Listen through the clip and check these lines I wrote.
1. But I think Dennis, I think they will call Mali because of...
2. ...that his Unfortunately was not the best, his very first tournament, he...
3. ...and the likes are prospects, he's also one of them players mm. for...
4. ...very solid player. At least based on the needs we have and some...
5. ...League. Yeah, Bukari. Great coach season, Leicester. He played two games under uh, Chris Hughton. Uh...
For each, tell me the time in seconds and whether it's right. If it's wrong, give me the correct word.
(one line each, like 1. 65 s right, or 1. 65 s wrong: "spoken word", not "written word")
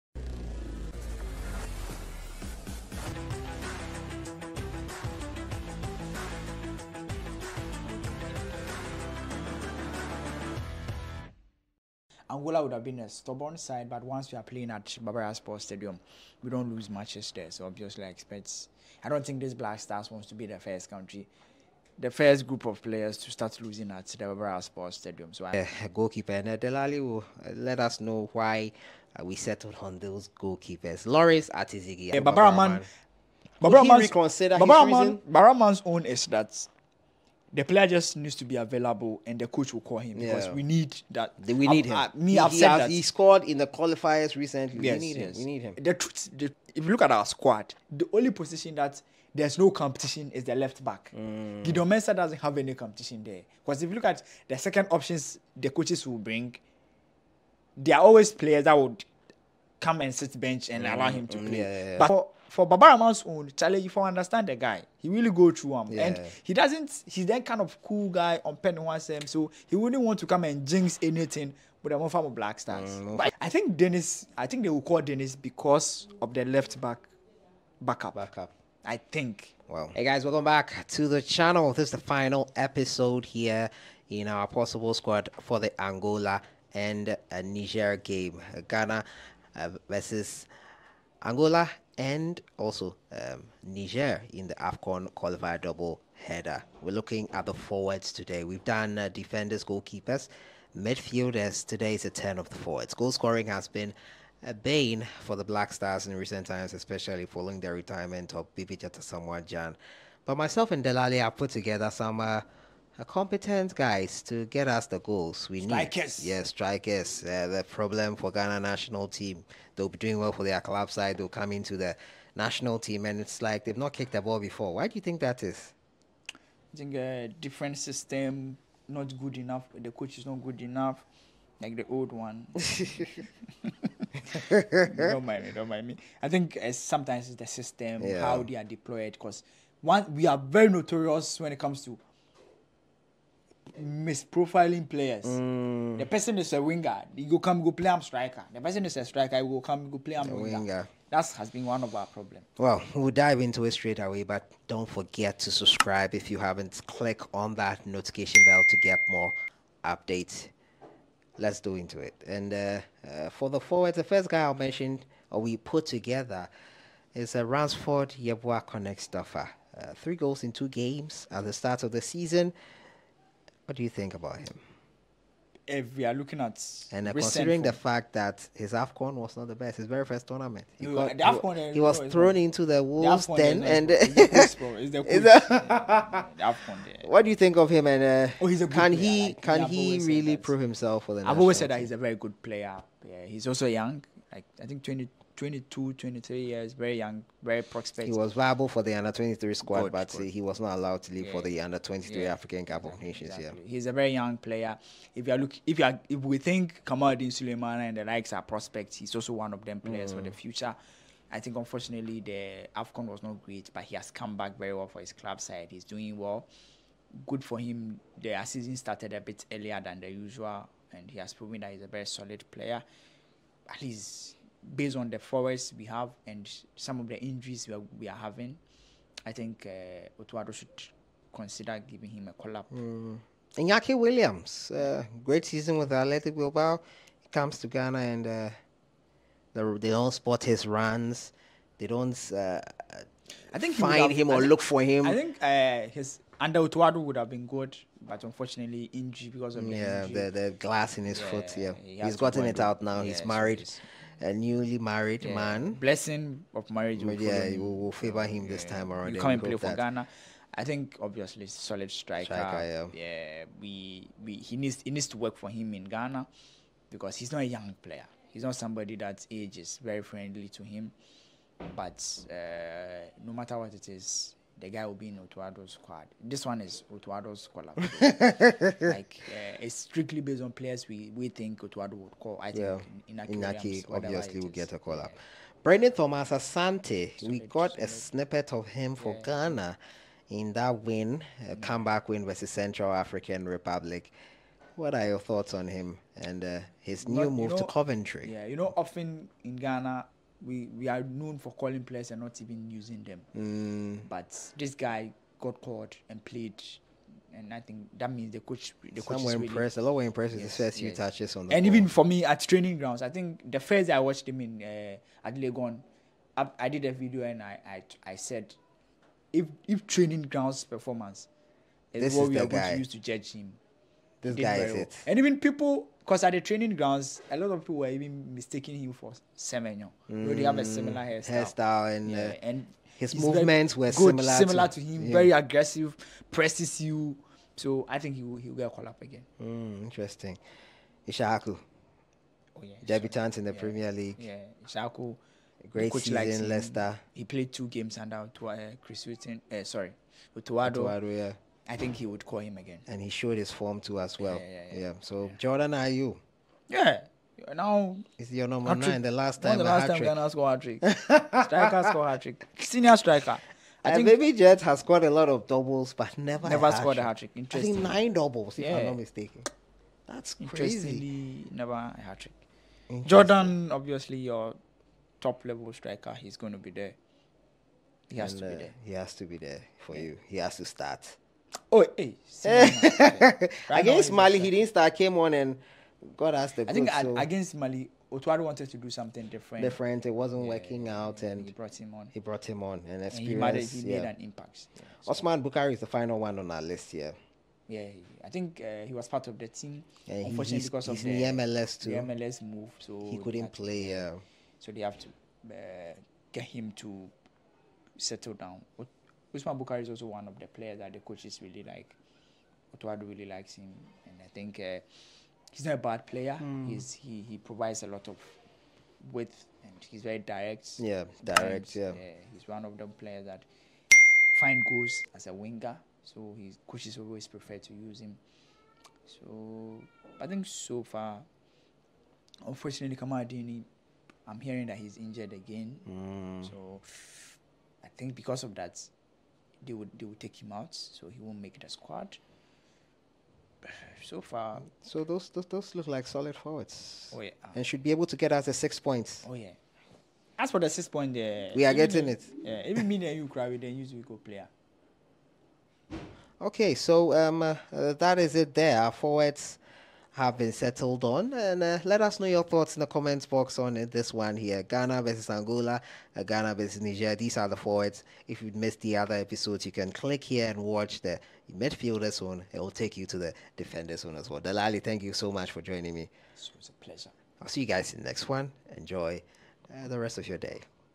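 1. 73 s wrong: "Dennis", not "Mali"
2. 178 s wrong: "Afcon", not "Unfortunately"
3. 207 s right
4. 221 s wrong: "forwards", not "needs"
5. 343 s wrong: "Issahaku", not "Bukari".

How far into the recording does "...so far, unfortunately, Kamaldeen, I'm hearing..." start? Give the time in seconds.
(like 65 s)
430 s.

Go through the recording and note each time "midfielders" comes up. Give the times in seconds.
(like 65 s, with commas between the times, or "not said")
100 s, 471 s.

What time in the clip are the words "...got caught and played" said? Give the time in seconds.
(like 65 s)
305 s.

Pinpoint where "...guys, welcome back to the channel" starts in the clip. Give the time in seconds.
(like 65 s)
80 s.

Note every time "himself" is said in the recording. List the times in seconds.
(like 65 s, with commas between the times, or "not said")
190 s.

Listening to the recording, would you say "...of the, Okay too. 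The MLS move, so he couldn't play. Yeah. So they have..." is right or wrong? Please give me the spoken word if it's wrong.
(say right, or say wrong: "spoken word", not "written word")
wrong: "MLS", not "Okay".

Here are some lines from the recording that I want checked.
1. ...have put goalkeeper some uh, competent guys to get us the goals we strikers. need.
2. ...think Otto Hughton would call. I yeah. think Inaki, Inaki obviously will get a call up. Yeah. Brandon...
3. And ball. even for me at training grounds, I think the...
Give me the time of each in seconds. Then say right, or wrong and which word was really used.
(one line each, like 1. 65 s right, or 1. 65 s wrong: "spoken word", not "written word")
1. 111 s wrong: "together", not "goalkeeper"
2. 281 s wrong: "Addo", not "Hughton"
3. 311 s right.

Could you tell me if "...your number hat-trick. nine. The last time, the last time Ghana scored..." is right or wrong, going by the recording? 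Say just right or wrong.
right.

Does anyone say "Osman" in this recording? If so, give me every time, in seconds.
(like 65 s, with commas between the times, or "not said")
395 s.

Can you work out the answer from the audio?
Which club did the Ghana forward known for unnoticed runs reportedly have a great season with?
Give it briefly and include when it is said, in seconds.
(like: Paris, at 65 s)
Athletic Bilbao, at 235 s.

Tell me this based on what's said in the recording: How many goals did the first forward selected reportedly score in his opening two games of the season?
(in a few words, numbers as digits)
3.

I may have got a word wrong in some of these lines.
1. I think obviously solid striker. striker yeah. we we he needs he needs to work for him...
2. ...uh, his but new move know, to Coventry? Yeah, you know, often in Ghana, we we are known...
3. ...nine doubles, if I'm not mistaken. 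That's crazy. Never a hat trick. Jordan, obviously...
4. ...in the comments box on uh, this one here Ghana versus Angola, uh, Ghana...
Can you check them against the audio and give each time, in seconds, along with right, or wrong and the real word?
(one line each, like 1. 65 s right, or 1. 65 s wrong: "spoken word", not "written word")
1. 260 s right
2. 296 s right
3. 367 s right
4. 462 s right.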